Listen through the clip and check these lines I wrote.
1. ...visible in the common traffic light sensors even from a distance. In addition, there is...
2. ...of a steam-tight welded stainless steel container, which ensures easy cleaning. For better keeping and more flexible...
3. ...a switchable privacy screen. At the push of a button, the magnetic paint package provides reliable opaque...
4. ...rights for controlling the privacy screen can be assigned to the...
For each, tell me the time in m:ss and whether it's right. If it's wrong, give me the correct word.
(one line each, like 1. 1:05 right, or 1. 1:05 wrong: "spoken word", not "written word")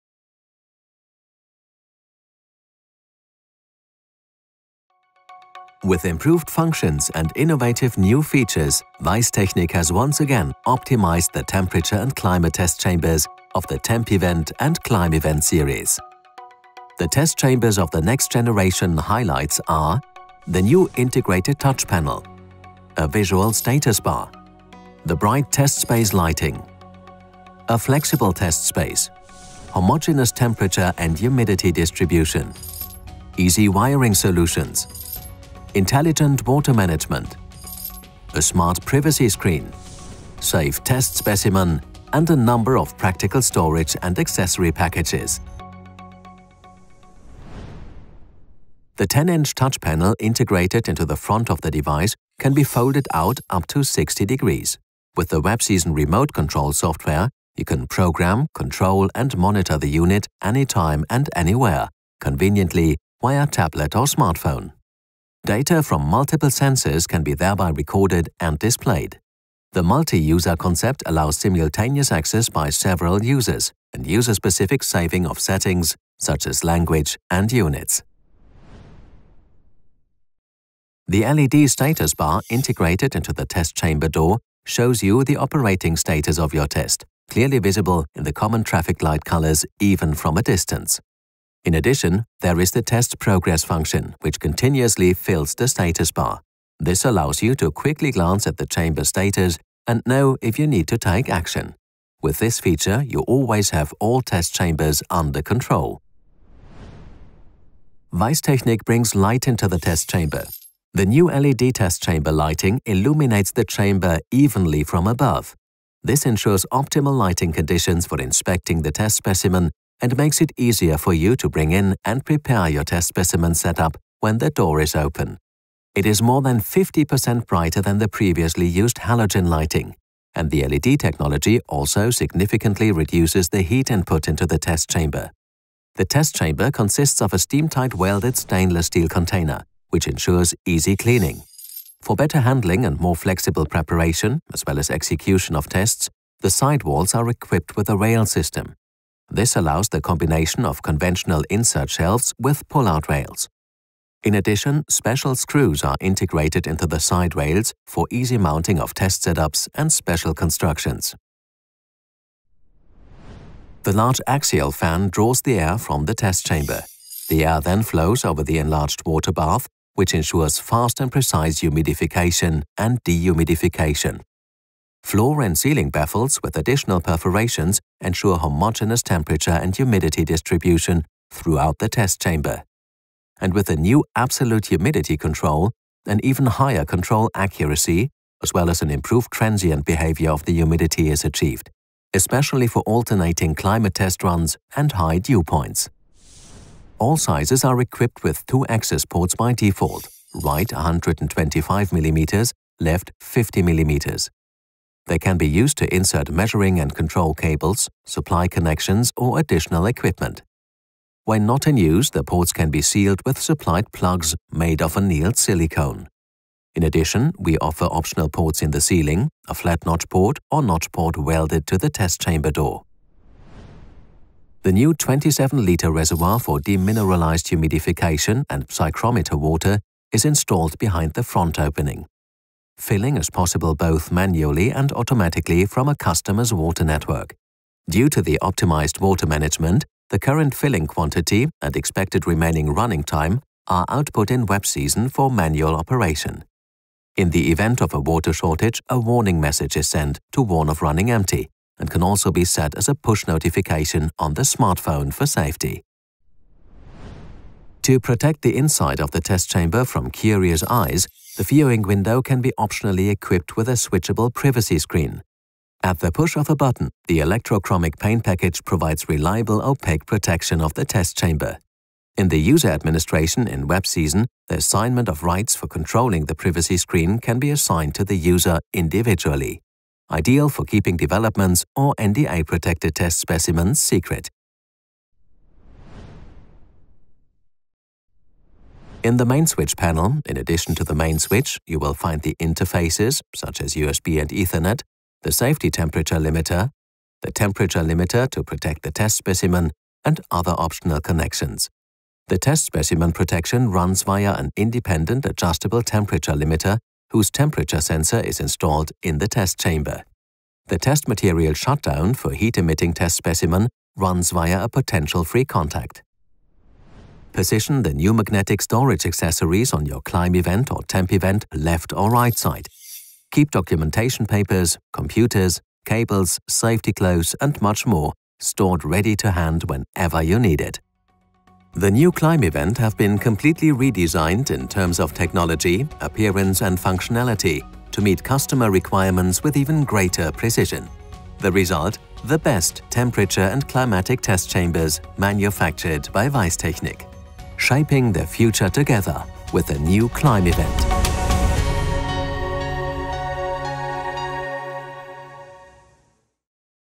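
1. 1:27 wrong: "colors", not "sensors"
2. 2:17 wrong: "handling", not "keeping"
3. 4:23 wrong: "electrochromic", not "magnetic"
4. 4:35 right.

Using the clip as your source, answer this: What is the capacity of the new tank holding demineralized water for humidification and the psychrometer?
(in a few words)
27 litres.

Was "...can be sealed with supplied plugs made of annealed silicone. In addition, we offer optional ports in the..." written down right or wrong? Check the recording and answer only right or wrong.
right.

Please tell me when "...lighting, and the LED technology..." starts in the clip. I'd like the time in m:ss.
2:09.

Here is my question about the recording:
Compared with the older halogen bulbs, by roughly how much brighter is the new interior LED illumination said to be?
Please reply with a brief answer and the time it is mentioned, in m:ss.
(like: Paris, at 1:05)
More than 50%, at 2:06.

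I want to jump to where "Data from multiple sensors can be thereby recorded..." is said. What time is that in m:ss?
1:05.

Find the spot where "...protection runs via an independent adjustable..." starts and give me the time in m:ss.
5:03.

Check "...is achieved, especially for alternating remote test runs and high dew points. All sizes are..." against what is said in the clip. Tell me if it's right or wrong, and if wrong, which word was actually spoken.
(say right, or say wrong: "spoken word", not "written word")
wrong: "climate", not "remote".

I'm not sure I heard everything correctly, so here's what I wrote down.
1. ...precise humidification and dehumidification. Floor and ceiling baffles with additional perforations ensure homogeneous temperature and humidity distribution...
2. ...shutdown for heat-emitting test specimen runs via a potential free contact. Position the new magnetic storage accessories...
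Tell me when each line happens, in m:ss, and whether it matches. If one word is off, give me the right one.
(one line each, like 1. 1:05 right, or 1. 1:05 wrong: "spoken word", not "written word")
1. 2:51 right
2. 5:11 right.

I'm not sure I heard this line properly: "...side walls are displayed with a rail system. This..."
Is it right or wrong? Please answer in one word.
wrong.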